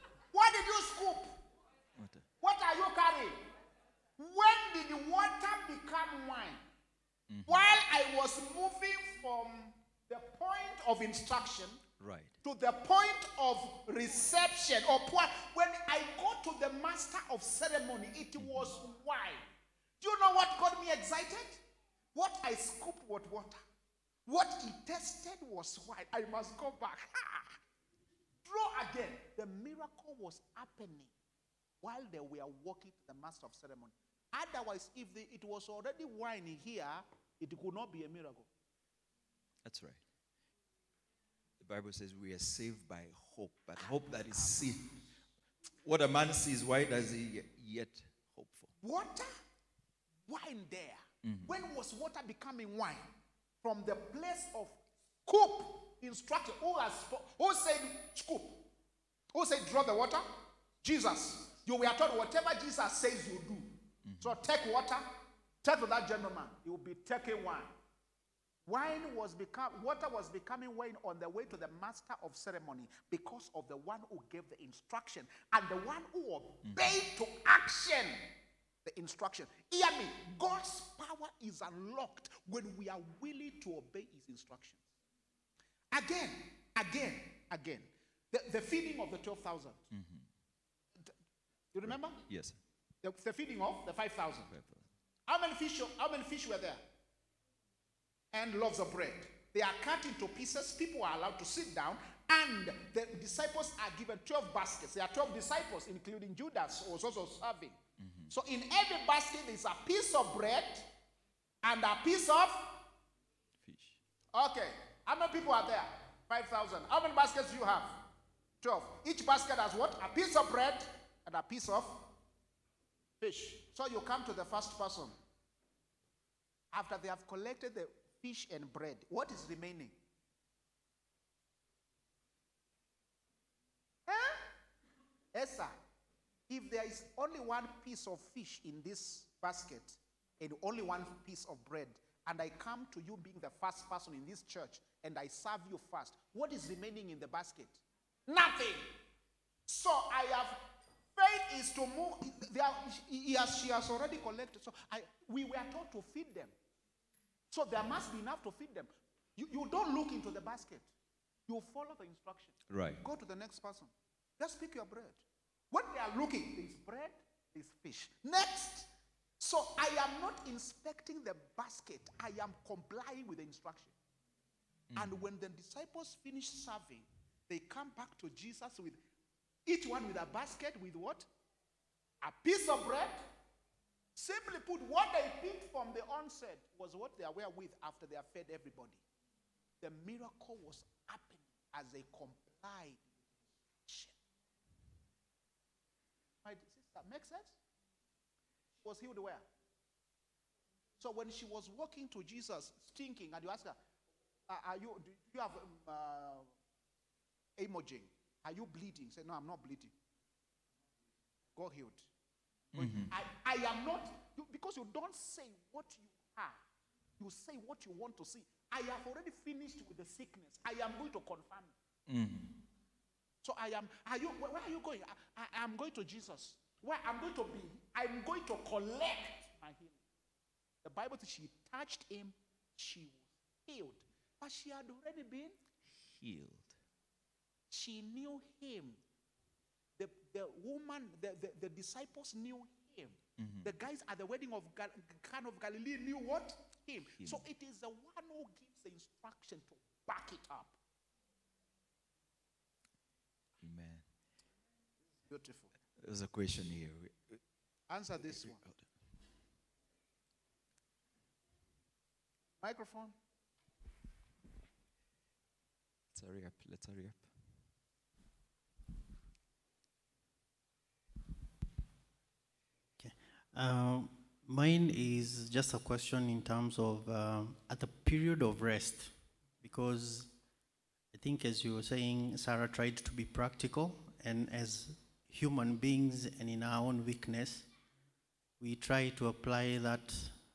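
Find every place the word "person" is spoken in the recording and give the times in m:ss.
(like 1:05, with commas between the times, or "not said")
2:04, 2:23, 2:43.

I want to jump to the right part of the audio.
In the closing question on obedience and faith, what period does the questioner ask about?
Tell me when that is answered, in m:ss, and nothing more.
4:37.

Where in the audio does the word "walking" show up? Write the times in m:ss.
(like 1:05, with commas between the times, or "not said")
0:32, 3:21.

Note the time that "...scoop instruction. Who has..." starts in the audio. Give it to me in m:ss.
0:55.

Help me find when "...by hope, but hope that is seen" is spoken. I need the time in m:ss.
0:42.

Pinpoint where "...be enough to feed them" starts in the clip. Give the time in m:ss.
2:38.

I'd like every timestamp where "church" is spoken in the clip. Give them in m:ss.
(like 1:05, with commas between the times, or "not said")
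2:24.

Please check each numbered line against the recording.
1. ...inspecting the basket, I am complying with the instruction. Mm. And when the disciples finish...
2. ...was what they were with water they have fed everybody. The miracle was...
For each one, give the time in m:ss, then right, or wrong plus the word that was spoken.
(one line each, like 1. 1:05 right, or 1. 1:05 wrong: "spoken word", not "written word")
1. 2:50 right
2. 3:06 wrong: "after", not "water".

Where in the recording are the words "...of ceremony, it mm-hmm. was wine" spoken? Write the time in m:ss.
0:17.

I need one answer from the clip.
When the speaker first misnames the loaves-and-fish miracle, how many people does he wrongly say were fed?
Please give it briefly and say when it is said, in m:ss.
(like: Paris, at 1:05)
12,000, at 1:29.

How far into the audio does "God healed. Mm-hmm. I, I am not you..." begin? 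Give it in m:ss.
3:31.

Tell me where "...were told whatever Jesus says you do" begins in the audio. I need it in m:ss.
1:01.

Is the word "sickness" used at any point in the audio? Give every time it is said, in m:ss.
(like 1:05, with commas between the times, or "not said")
3:40.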